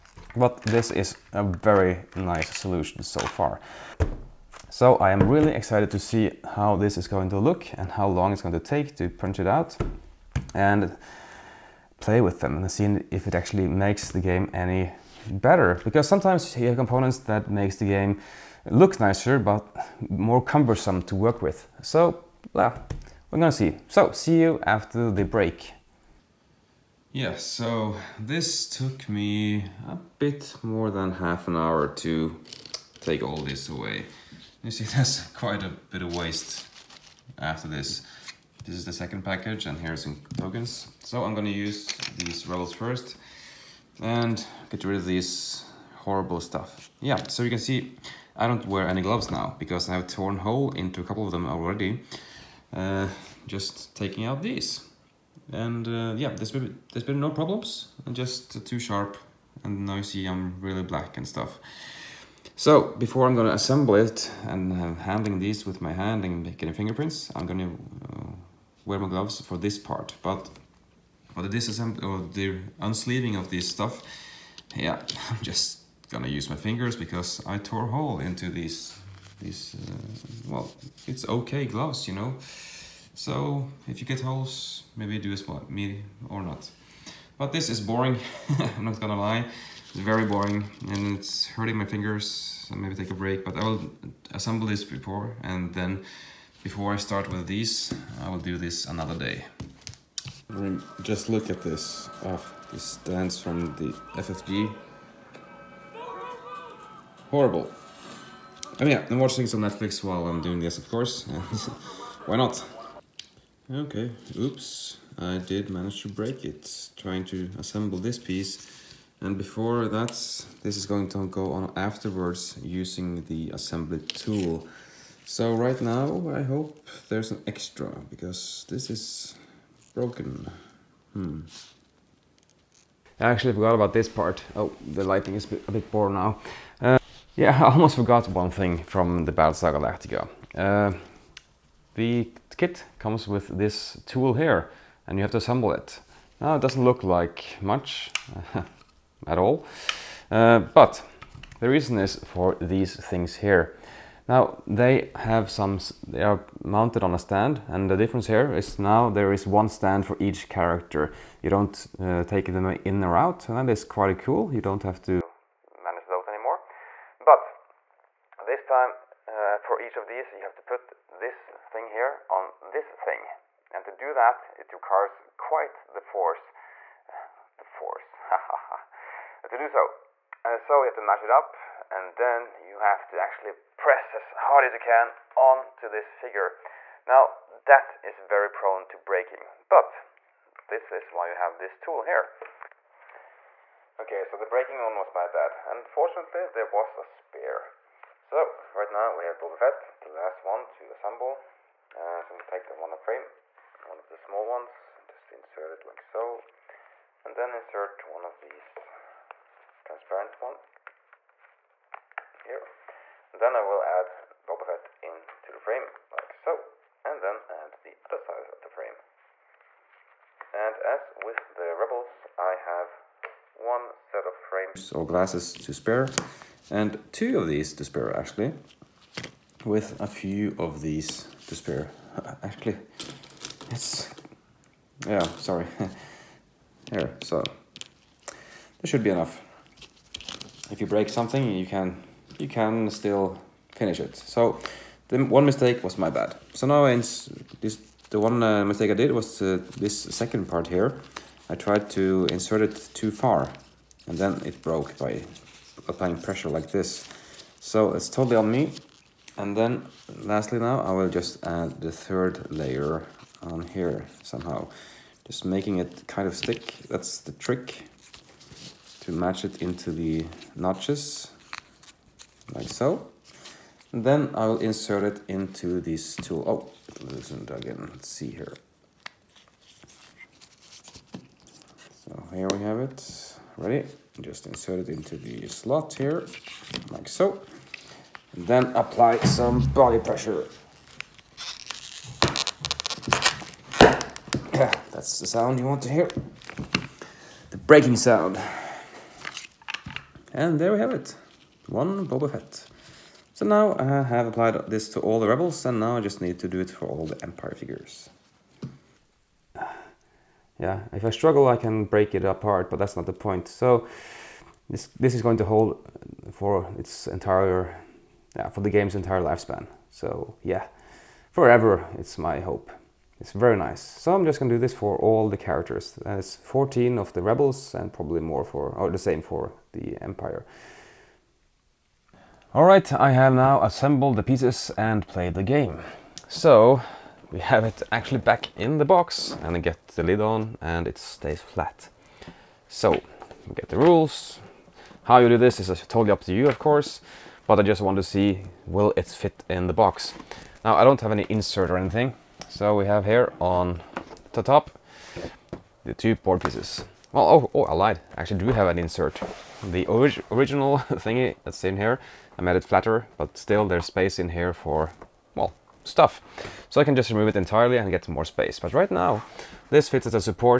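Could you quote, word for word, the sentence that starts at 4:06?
So now this the one uh, mistake I did was uh, this second part here.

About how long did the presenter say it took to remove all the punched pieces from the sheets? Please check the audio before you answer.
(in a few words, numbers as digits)
more than half an hour.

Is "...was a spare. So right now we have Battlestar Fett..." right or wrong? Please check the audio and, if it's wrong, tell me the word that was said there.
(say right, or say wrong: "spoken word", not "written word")
wrong: "Boba", not "Battlestar".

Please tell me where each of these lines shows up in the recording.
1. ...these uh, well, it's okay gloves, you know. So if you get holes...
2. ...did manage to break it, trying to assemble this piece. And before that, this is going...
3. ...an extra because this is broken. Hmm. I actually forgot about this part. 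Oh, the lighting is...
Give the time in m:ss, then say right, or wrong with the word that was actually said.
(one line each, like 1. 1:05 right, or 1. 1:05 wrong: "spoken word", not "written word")
1. 1:19 right
2. 1:55 right
3. 2:07 right.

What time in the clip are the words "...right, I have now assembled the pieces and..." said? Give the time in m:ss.
5:32.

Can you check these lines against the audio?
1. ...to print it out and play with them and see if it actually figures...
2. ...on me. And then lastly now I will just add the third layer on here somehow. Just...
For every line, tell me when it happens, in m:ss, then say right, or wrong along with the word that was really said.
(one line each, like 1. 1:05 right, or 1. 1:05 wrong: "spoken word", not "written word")
1. 0:08 wrong: "makes", not "figures"
2. 4:18 right.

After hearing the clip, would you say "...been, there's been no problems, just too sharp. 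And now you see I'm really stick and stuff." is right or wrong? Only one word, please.
wrong.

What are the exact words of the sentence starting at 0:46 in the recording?
Yeah, so you can see I don't wear any gloves now because I have torn hole into a couple of them already.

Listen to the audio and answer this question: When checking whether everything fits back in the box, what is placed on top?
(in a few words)
the two board pieces.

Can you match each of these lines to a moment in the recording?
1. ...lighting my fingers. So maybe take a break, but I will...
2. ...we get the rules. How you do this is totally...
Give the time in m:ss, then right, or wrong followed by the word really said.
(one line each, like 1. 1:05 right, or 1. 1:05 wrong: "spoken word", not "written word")
1. 1:31 wrong: "hurting", not "lighting"
2. 5:43 right.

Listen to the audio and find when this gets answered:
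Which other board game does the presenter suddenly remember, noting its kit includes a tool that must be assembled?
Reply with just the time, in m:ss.
2:19.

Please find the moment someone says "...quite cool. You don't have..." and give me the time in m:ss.
2:43.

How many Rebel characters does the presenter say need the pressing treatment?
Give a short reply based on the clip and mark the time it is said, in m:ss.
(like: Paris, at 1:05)
14, at 5:26.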